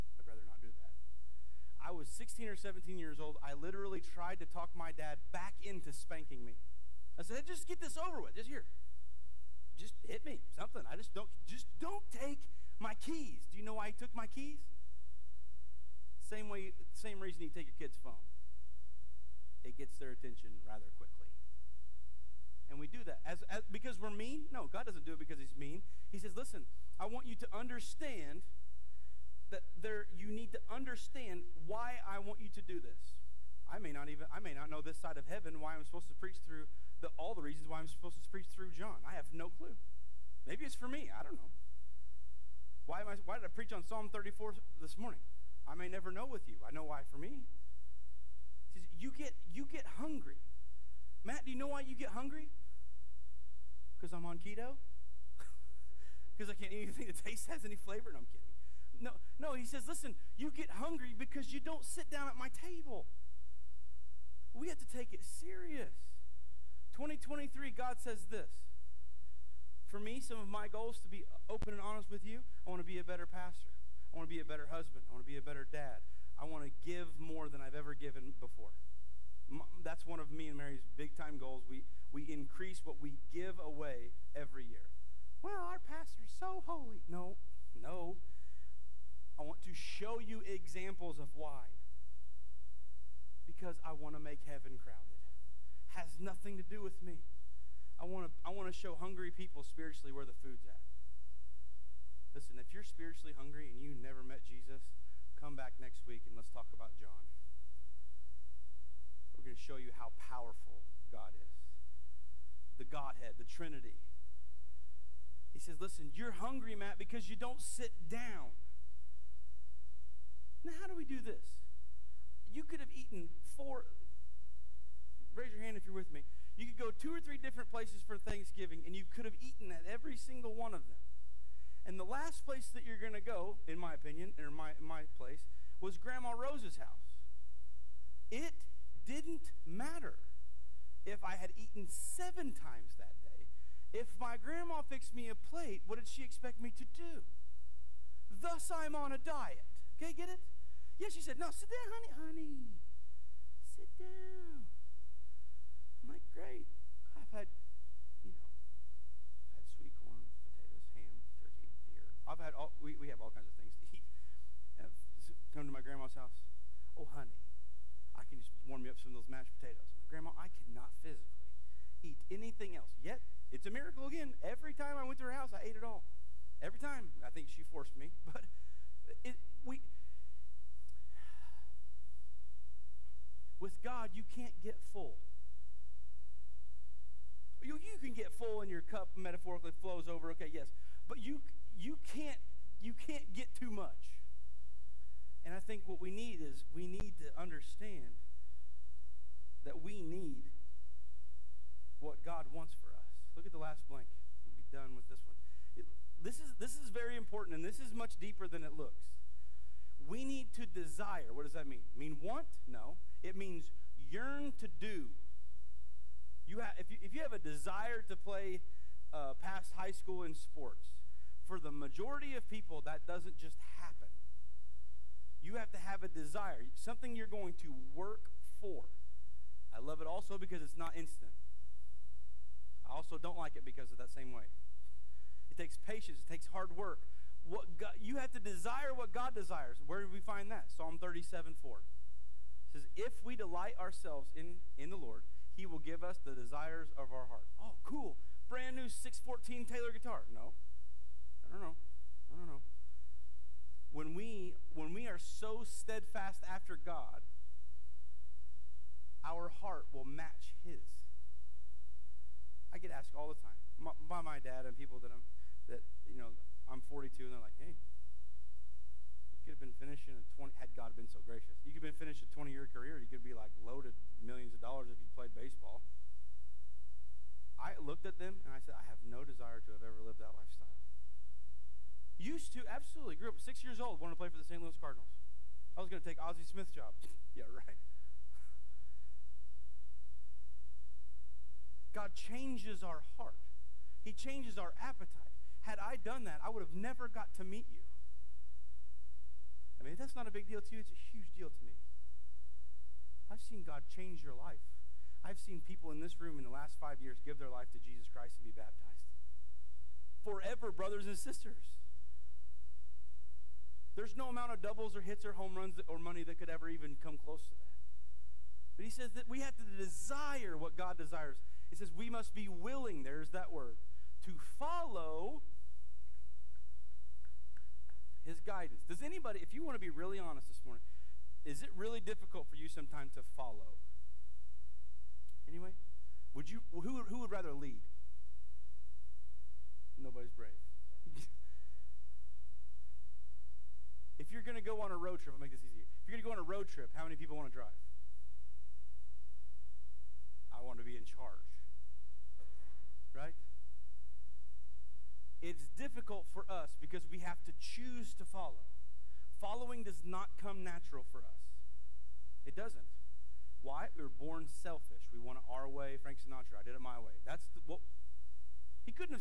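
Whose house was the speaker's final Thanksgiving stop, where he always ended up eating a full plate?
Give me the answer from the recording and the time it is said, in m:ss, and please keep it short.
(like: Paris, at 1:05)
Grandma Rose's house, at 2:15.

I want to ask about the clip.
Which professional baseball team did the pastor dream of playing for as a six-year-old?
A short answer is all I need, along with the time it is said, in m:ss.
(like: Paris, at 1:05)
St. Louis Cardinals, at 4:44.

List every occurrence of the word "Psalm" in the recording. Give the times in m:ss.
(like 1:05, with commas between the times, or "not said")
0:43, 4:00.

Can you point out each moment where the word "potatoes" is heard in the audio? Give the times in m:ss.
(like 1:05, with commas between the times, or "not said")
2:49.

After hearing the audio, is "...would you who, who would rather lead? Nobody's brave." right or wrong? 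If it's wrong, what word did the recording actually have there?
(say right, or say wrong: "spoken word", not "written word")
right.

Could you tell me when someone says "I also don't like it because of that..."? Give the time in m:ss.
3:52.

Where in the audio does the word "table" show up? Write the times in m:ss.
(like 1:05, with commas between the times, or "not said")
1:02.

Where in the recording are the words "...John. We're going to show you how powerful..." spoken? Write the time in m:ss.
1:46.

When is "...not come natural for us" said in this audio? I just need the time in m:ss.
6:00.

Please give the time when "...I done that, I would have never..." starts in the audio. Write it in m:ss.
4:55.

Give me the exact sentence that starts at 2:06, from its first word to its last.
You could go two or three different places for Thanksgiving, and you could have eaten at every single one of them.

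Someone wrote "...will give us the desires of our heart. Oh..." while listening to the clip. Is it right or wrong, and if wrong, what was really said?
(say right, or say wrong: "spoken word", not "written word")
right.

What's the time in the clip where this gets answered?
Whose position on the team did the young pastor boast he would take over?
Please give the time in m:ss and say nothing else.
4:46.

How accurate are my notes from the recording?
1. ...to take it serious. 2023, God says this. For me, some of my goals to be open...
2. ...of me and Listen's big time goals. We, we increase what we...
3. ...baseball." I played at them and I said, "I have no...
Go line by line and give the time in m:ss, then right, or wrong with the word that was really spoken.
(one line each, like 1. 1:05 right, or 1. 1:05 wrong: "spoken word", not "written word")
1. 1:04 right
2. 1:20 wrong: "Mary", not "Listen"
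3. 4:35 wrong: "looked", not "played".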